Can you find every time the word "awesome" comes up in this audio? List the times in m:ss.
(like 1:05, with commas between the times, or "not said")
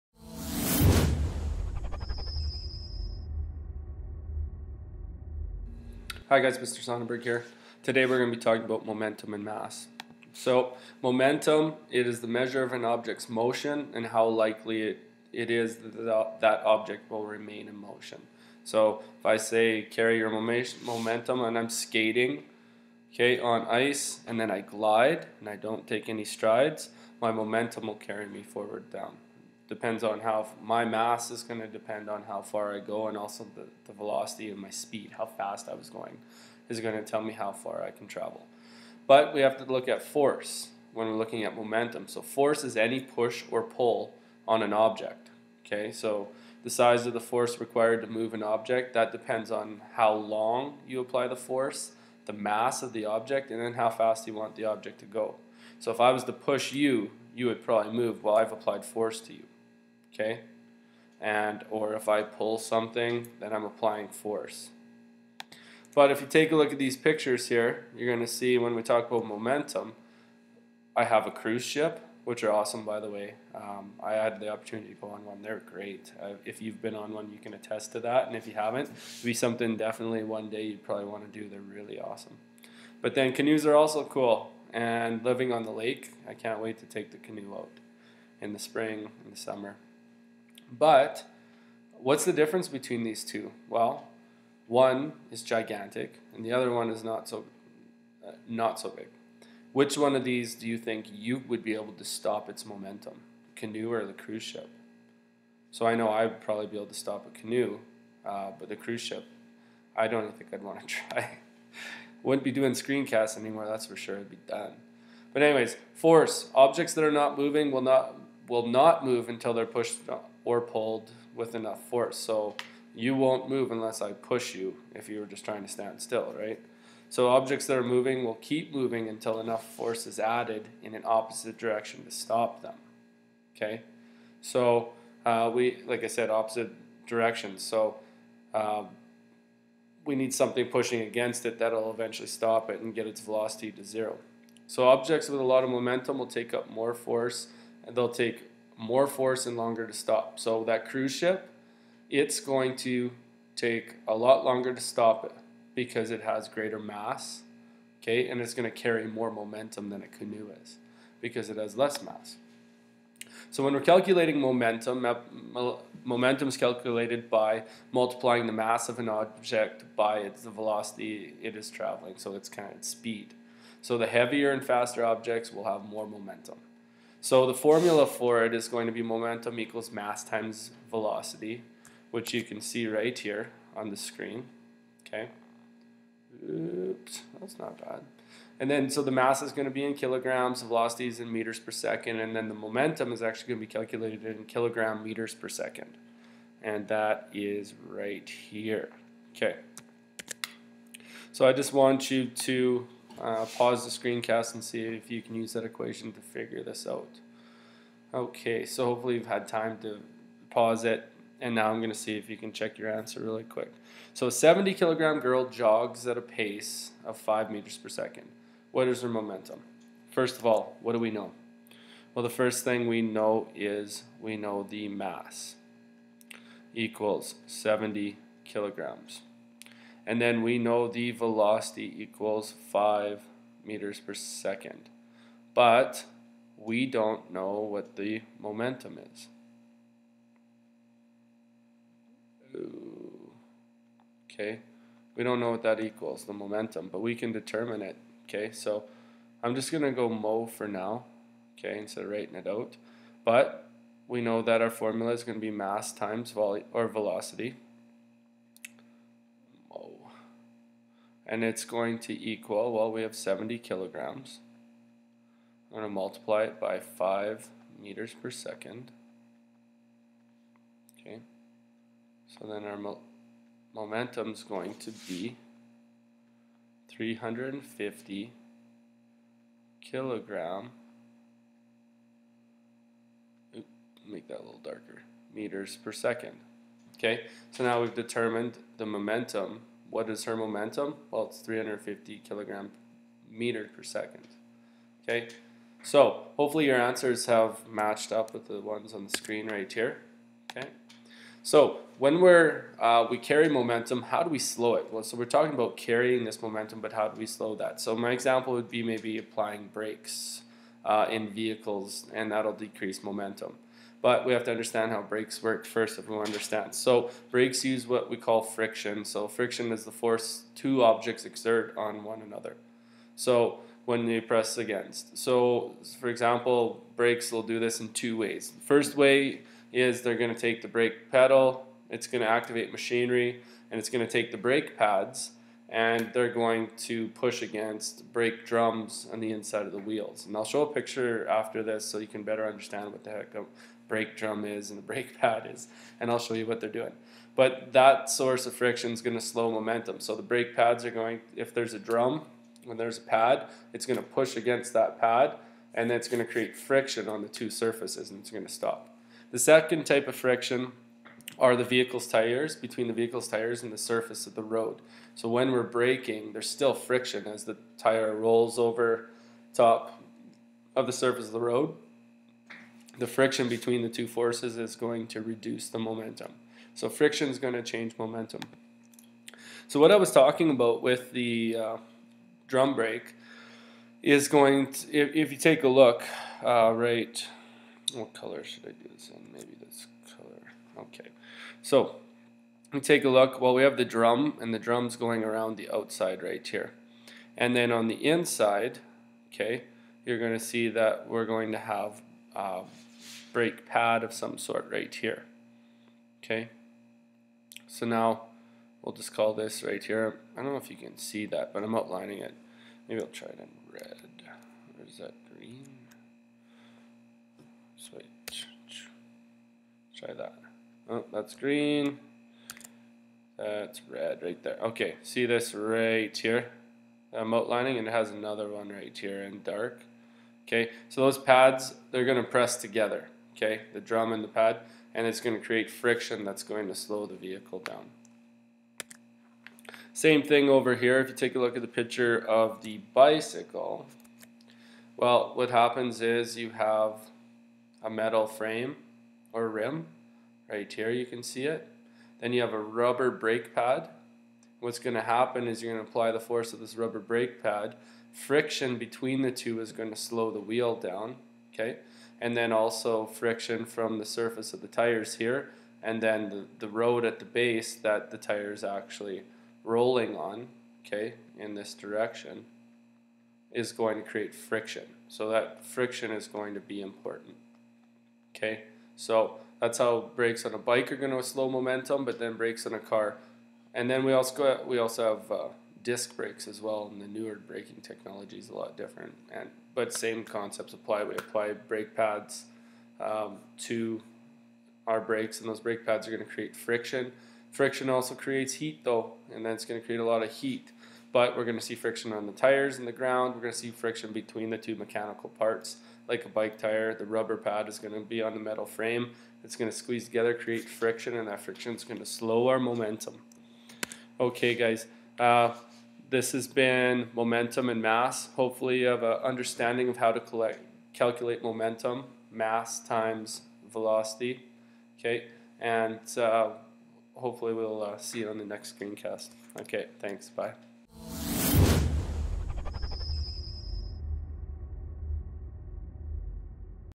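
1:12, 1:21.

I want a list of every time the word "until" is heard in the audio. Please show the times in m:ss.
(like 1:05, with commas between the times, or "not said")
1:59, 2:09.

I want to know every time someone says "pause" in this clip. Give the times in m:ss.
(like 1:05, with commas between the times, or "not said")
3:23, 3:30.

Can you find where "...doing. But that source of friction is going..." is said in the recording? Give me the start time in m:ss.
5:46.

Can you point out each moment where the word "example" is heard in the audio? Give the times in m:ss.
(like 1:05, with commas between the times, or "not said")
5:08, 5:26.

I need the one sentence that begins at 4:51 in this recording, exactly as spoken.
Well, it's 350 kilogram meter per second.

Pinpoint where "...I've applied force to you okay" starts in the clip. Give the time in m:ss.
0:58.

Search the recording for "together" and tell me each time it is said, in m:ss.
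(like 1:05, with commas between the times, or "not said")
7:12, 8:30.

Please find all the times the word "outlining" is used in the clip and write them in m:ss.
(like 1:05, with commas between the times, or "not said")
6:51, 7:07.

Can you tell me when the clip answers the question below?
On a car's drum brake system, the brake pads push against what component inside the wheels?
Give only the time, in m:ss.
5:38.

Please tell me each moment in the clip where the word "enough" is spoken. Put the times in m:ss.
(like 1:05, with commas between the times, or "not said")
2:01, 2:09.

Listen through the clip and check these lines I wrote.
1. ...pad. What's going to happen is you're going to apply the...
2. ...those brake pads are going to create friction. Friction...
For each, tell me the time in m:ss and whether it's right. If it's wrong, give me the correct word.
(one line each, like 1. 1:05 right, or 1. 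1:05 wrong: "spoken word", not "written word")
1. 7:33 right
2. 8:15 right.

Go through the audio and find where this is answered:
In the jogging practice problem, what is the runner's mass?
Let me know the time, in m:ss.
3:34.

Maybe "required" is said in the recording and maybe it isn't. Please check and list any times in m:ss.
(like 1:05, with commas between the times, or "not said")
0:47.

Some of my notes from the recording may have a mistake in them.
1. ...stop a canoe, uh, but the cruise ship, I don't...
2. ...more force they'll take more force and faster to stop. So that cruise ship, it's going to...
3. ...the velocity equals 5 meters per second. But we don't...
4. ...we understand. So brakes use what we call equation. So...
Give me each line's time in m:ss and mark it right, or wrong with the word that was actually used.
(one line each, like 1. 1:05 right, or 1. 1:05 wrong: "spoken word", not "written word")
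1. 1:46 right
2. 2:26 wrong: "longer", not "faster"
3. 3:50 right
4. 5:16 wrong: "friction", not "equation".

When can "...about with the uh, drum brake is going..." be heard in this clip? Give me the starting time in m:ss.
6:20.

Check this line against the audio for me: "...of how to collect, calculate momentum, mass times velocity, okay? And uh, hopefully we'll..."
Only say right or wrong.
right.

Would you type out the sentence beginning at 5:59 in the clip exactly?
The second type of friction are the vehicle's tires between the vehicle's tires and the surface of the road.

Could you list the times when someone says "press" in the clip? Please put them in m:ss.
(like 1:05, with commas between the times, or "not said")
5:24, 7:12.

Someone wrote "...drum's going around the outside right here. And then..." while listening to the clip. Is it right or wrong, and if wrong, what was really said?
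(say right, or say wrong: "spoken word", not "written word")
right.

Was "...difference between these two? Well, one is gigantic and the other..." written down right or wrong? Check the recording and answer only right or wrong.
right.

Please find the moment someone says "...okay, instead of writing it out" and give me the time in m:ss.
4:11.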